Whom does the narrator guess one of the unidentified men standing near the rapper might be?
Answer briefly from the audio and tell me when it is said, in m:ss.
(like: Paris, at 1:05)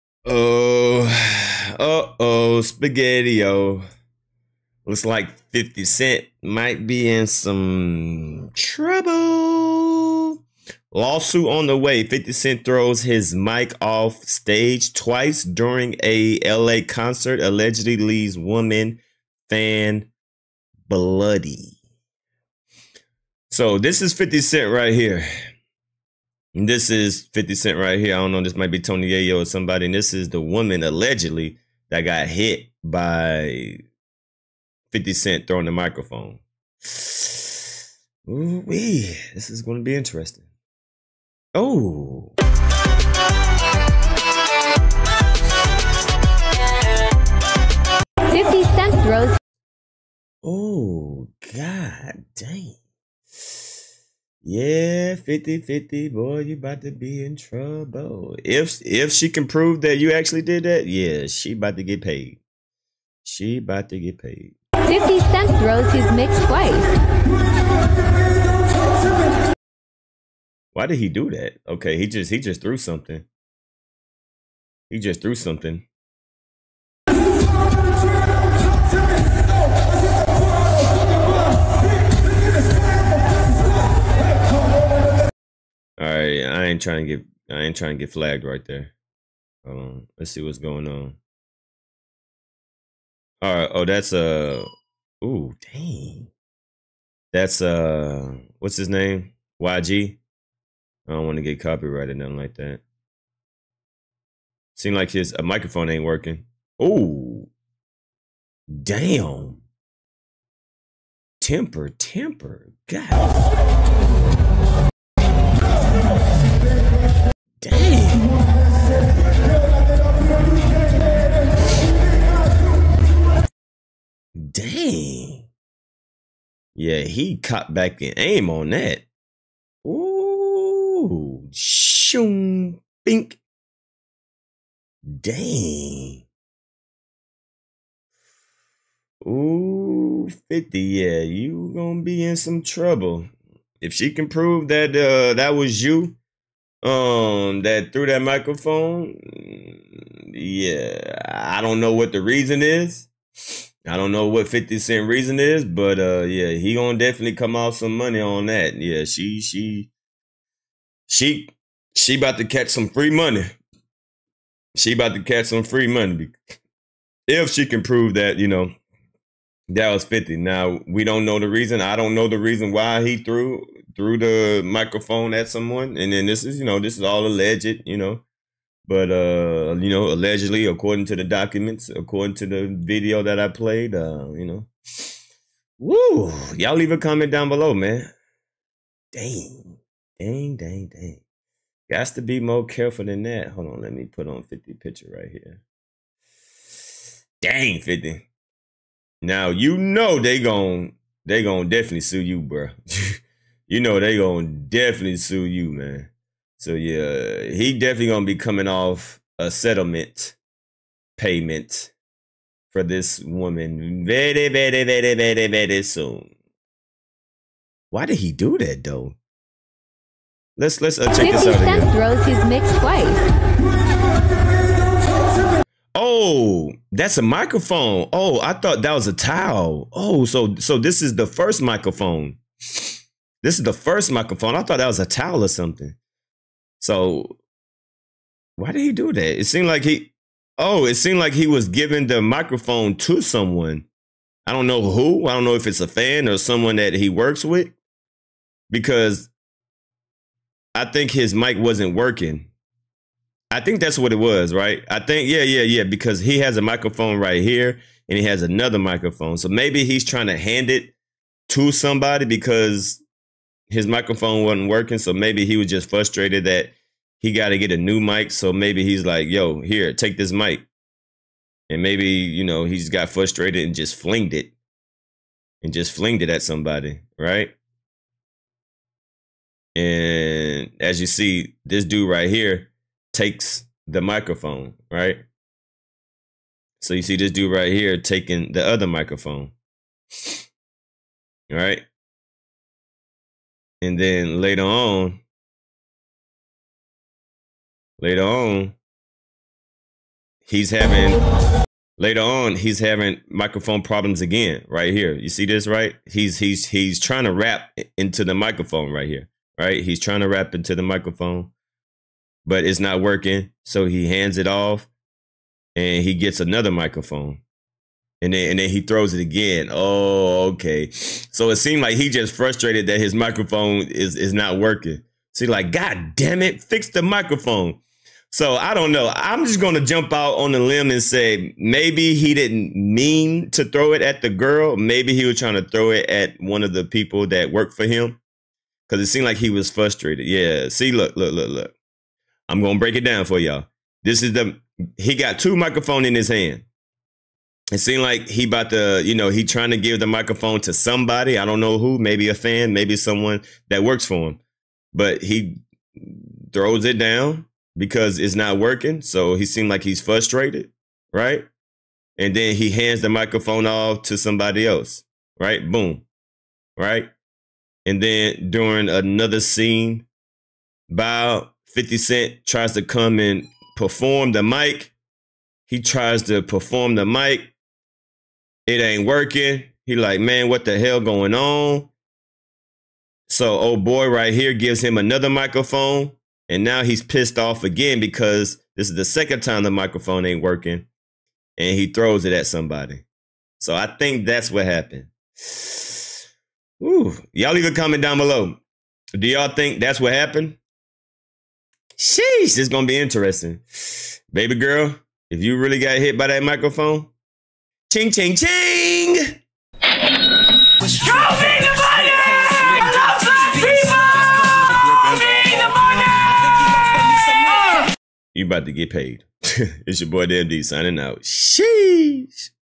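Tony Yayo, at 0:28.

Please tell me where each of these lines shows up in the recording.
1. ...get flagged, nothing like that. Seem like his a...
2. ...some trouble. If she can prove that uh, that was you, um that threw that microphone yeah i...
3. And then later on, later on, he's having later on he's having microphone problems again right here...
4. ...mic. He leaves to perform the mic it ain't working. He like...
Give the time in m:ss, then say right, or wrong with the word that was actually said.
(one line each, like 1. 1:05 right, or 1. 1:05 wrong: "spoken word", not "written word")
1. 1:41 wrong: "copyrighted", not "flagged"
2. 2:22 right
3. 4:53 right
4. 6:14 wrong: "tries", not "leaves".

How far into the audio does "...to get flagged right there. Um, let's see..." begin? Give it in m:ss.
1:27.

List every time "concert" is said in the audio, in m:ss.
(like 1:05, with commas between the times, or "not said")
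0:16.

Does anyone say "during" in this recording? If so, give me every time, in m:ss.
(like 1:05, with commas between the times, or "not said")
0:15, 6:08.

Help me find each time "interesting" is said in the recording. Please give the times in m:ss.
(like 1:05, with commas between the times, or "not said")
0:39, 6:42.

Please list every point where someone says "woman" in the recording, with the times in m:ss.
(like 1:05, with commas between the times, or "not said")
0:18, 0:30, 3:33.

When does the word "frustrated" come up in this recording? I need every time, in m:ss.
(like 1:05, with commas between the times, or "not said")
4:25, 4:33, 5:22, 5:39, 6:00.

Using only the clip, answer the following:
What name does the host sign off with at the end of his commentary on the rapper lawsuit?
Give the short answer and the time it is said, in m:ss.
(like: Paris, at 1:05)
DMD, at 7:00.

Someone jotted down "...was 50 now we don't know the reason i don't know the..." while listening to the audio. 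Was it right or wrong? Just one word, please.
right.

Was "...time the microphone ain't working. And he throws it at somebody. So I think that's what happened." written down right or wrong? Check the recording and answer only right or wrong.
right.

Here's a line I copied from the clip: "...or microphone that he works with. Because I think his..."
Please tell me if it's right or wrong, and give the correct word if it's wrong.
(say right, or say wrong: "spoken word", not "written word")
wrong: "someone", not "microphone".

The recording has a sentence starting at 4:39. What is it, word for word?
And as you see, this dude right here takes the microphone, right?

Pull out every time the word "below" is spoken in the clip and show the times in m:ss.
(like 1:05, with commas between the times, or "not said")
3:07, 6:38.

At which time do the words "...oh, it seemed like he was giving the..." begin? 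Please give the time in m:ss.
4:00.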